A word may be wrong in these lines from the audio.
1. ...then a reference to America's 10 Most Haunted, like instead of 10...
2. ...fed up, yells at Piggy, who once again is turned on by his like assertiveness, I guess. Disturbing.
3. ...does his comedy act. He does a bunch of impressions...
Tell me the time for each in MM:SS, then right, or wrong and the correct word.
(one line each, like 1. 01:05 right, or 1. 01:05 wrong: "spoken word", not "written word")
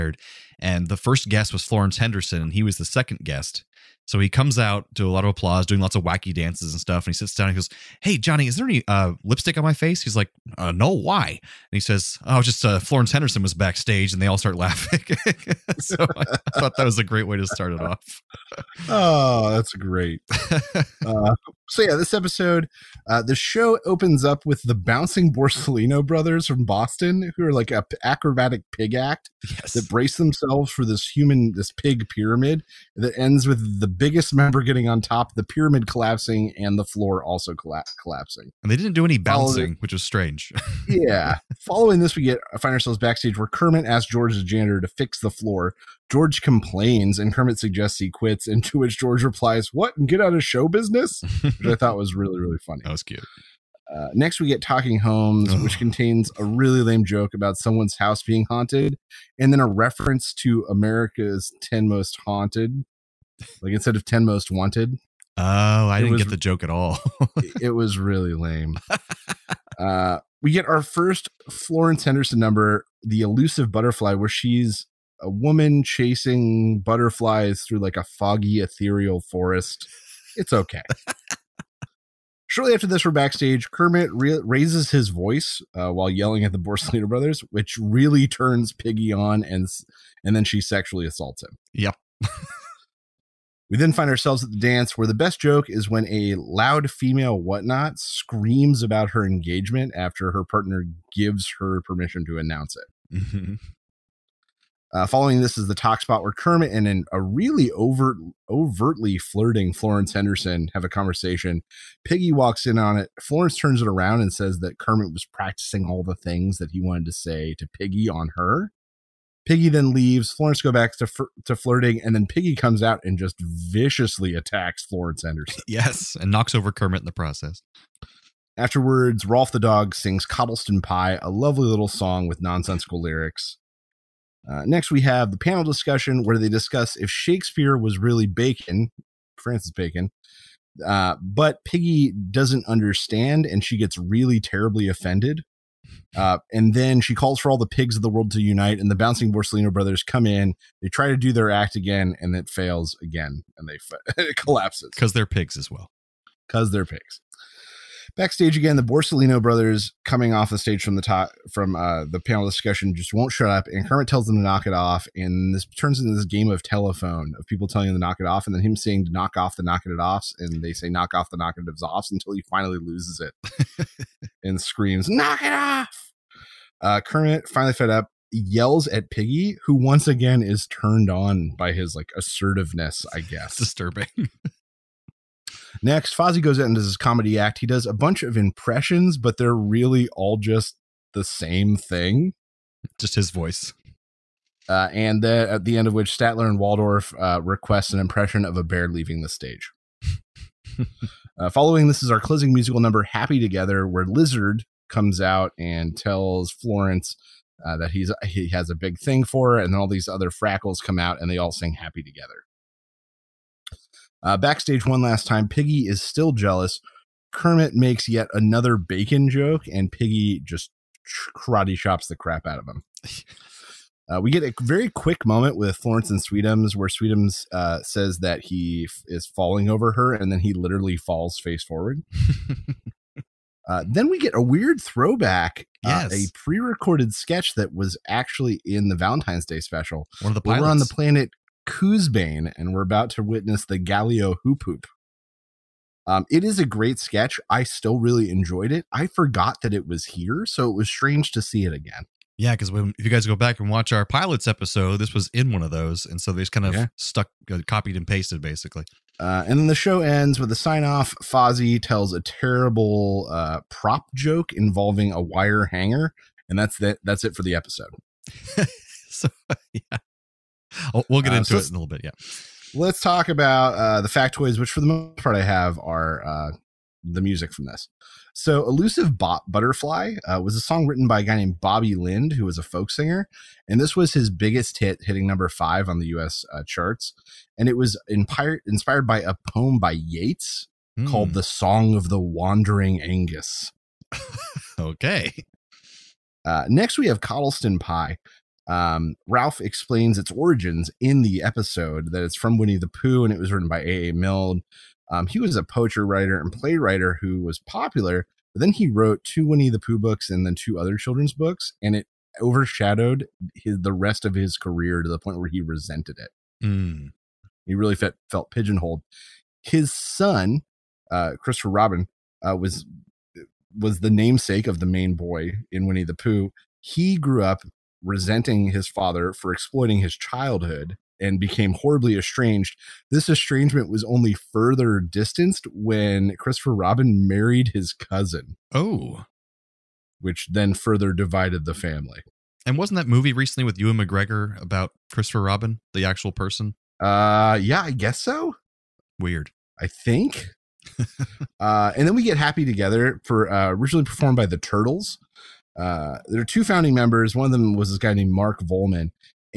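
1. 00:59 right
2. 02:57 right
3. 03:06 right.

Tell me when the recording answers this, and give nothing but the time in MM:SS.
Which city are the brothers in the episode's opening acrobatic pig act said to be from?
00:26.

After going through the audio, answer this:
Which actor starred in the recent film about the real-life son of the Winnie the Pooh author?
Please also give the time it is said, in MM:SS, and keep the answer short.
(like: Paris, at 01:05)
Ewan McGregor, at 05:43.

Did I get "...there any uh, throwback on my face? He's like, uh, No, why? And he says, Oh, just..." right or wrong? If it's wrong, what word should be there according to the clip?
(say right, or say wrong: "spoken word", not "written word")
wrong: "lipstick", not "throwback".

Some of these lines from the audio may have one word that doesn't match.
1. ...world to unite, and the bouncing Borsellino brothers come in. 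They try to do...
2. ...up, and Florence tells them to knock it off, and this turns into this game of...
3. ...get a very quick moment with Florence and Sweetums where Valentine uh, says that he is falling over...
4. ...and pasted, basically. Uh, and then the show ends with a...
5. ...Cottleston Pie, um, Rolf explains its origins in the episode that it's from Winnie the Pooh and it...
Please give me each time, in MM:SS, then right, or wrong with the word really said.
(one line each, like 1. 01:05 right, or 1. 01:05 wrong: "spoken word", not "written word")
1. 02:28 right
2. 02:43 wrong: "Kermit", not "Florence"
3. 03:44 wrong: "Sweetums", not "Valentine"
4. 04:17 right
5. 04:57 right.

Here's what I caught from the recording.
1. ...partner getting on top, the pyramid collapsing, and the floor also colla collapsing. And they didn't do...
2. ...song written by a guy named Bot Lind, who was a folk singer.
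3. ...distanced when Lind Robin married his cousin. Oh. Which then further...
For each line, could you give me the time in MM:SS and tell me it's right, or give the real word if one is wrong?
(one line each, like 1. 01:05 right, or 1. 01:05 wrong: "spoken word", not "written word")
1. 00:34 wrong: "member", not "partner"
2. 04:40 wrong: "Bobby", not "Bot"
3. 05:35 wrong: "Christopher", not "Lind".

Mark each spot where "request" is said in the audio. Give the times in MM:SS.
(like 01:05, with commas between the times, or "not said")
03:17.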